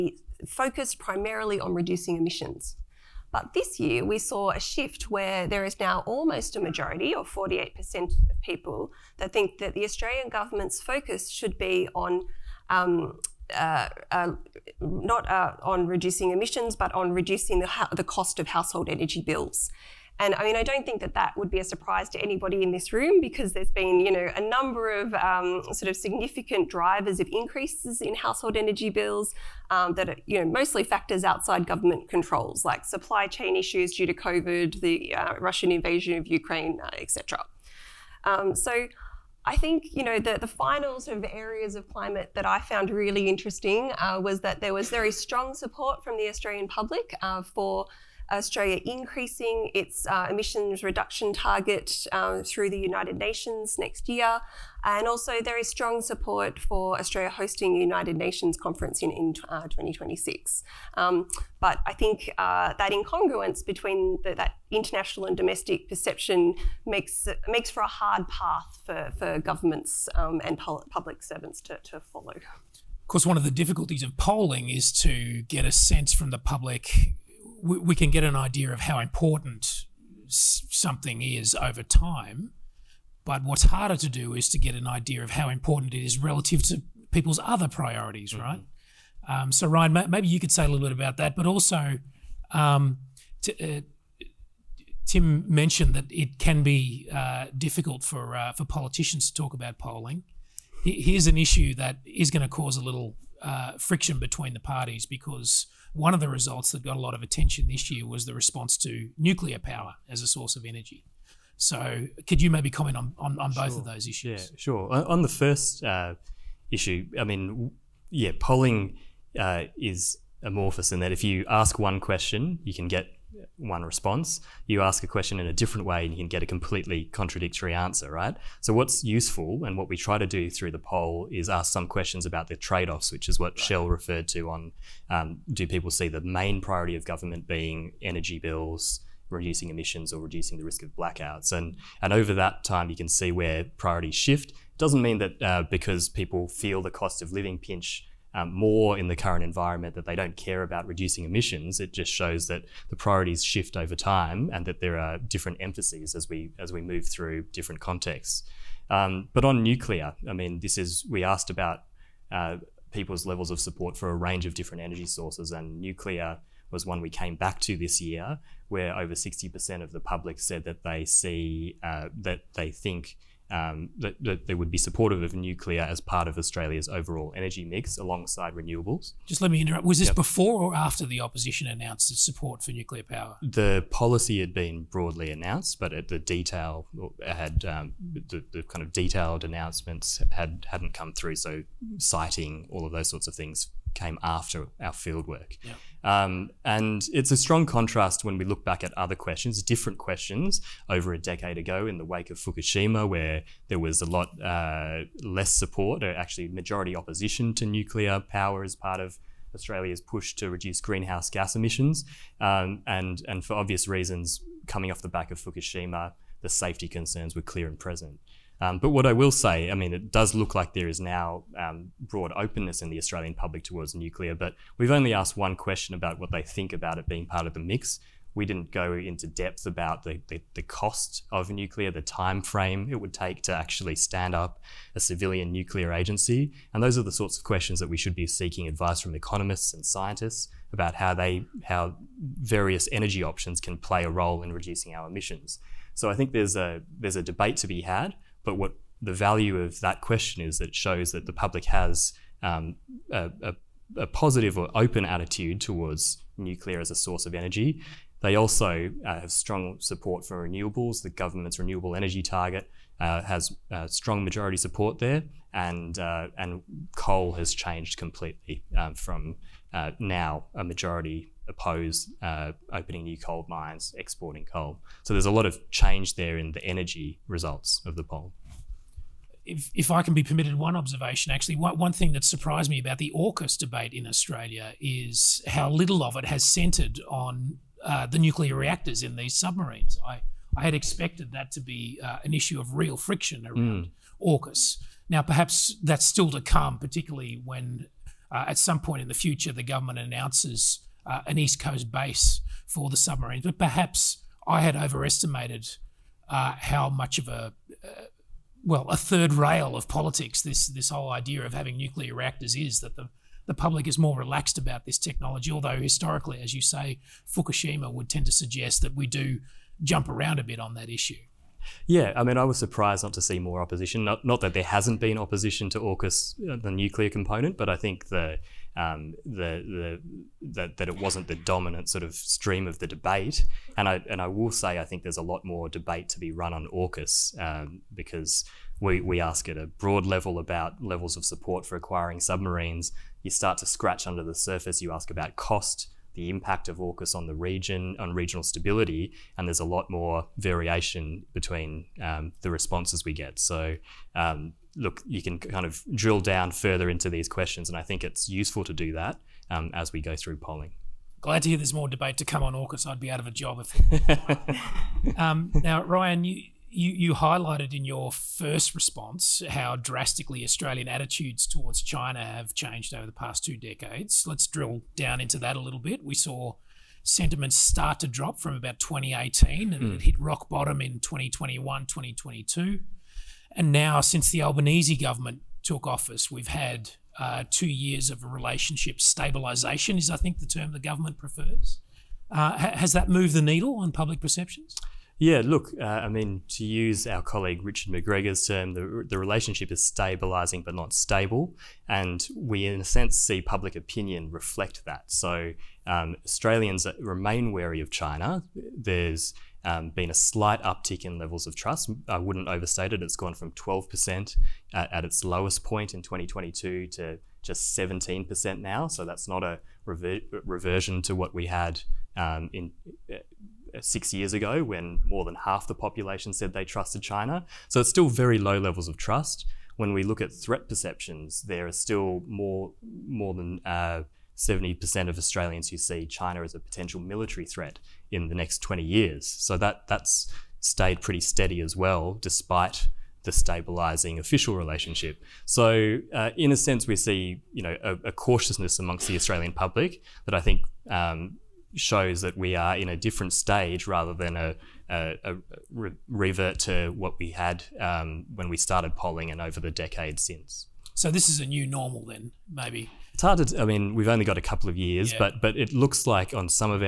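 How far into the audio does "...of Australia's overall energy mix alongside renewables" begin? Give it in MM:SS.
02:56.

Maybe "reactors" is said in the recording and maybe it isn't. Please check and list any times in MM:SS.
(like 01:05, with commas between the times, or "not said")
04:48, 05:12.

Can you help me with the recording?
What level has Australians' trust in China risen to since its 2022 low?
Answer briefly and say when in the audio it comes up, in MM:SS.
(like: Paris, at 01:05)
17%, at 06:57.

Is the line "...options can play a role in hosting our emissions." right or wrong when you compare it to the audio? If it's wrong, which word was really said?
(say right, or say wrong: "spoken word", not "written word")
wrong: "reducing", not "hosting".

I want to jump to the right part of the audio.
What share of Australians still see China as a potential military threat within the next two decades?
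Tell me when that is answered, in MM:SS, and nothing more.
07:13.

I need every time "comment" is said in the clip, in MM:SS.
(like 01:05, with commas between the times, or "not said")
01:52.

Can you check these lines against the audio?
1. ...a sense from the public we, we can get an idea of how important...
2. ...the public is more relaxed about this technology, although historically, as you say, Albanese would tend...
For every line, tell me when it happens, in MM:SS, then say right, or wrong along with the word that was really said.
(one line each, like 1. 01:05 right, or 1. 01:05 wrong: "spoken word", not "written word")
1. 01:15 right
2. 05:13 wrong: "Fukushima", not "Albanese".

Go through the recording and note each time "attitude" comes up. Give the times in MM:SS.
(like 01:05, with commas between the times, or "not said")
04:15, 06:10.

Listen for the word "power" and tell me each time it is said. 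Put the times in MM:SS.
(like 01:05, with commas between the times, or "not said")
01:49, 03:03, 03:28.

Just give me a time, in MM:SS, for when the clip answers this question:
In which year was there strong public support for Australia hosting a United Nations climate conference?
00:59.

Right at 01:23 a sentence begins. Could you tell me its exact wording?
But what's harder to do is to get an idea of how important it is relative to people's other priorities, mm -hmm.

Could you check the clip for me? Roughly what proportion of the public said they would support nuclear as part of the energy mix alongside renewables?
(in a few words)
over 60%.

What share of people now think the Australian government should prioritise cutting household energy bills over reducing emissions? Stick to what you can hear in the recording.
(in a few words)
48%.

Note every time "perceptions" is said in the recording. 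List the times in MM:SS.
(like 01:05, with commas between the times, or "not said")
01:05, 06:34, 07:10.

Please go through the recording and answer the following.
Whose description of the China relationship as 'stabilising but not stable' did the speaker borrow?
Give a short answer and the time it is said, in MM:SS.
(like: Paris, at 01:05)
Richard McGregor, at 06:37.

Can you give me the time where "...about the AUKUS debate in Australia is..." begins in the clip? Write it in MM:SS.
04:42.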